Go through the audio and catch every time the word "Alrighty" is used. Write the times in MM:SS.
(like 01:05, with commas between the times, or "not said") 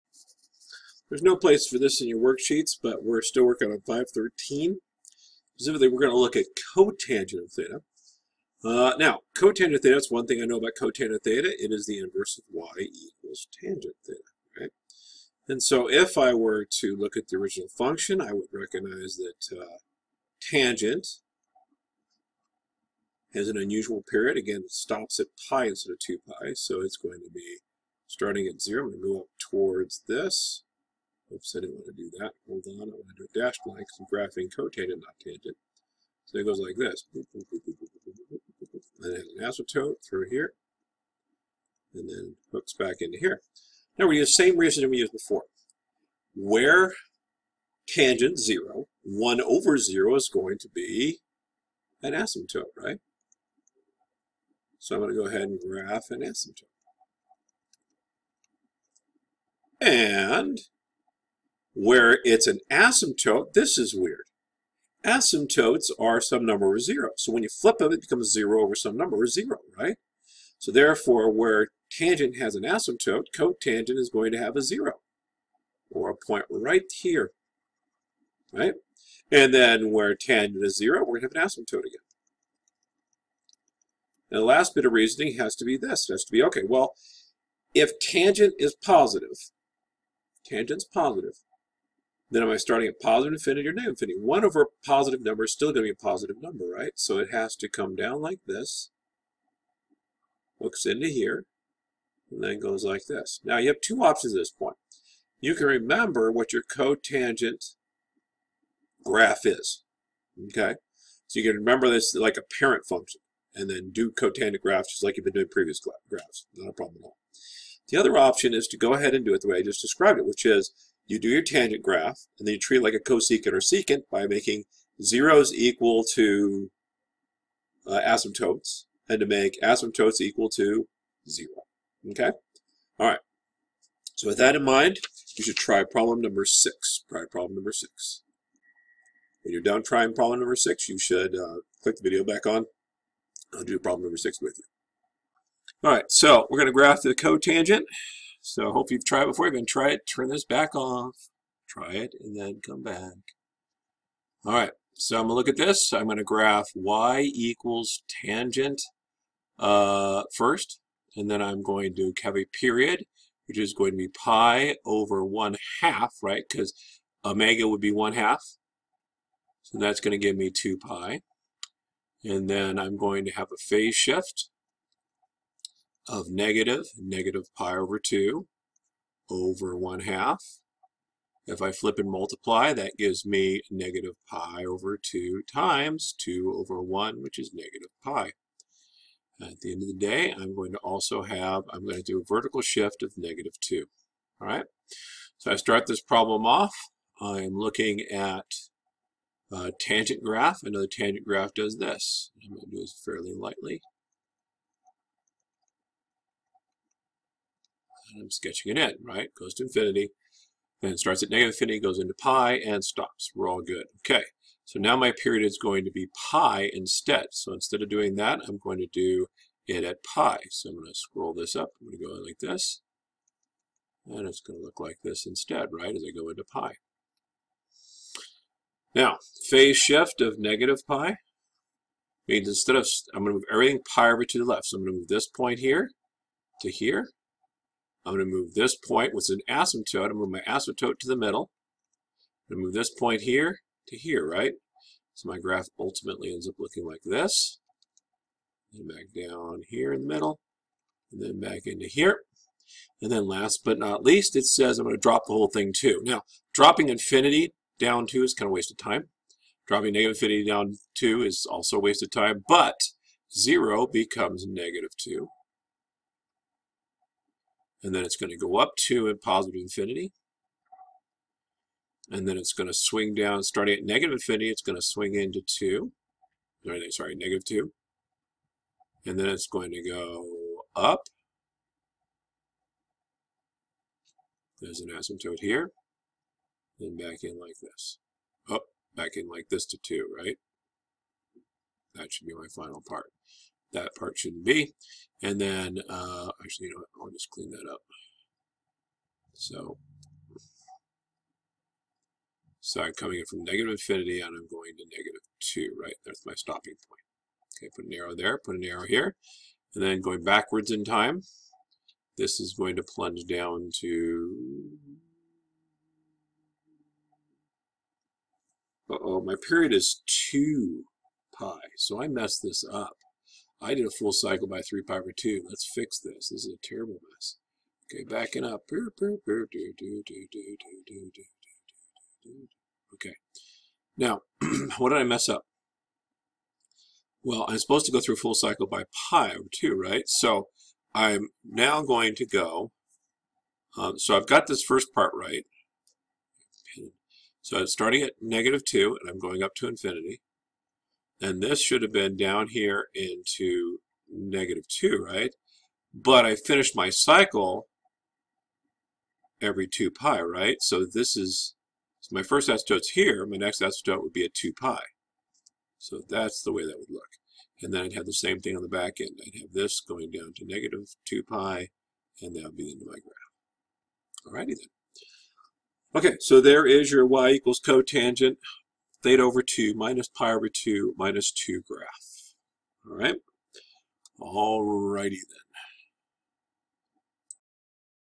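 06:14.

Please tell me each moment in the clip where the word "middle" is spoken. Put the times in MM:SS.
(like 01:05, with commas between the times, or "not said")
04:01, 04:10.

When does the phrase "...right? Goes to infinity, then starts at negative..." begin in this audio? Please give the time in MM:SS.
03:29.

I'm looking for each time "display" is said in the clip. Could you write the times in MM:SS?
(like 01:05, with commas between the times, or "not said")
not said.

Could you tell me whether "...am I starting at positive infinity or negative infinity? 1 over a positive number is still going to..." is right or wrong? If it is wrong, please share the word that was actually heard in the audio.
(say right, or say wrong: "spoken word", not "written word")
right.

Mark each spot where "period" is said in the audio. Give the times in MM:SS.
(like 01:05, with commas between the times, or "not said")
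00:24, 02:42, 03:35, 05:19.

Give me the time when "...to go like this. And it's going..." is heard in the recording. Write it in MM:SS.
03:41.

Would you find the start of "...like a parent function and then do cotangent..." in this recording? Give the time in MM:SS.
01:52.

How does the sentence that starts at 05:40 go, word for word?
So I'm now going to go, um, so I've got this first part right.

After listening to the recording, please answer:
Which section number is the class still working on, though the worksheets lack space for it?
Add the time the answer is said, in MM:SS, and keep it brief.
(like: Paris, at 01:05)
513, at 00:03.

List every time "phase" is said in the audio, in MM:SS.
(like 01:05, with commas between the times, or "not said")
02:53, 03:49.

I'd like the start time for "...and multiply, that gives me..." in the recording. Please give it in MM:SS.
03:01.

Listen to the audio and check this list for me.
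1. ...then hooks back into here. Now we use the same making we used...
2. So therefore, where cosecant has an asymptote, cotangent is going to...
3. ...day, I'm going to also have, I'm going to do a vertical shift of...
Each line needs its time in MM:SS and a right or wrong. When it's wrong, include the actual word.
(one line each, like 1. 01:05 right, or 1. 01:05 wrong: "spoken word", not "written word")
1. 00:42 wrong: "reasoning", not "making"
2. 01:10 wrong: "tangent", not "cosecant"
3. 03:09 right.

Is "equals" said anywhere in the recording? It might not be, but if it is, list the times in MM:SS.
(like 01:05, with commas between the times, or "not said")
00:12, 02:05, 02:10, 02:37, 06:17.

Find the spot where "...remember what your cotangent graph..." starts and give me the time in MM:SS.
01:45.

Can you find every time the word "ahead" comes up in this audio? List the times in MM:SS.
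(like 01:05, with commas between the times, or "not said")
00:55, 01:58.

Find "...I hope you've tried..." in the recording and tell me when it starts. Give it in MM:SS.
02:28.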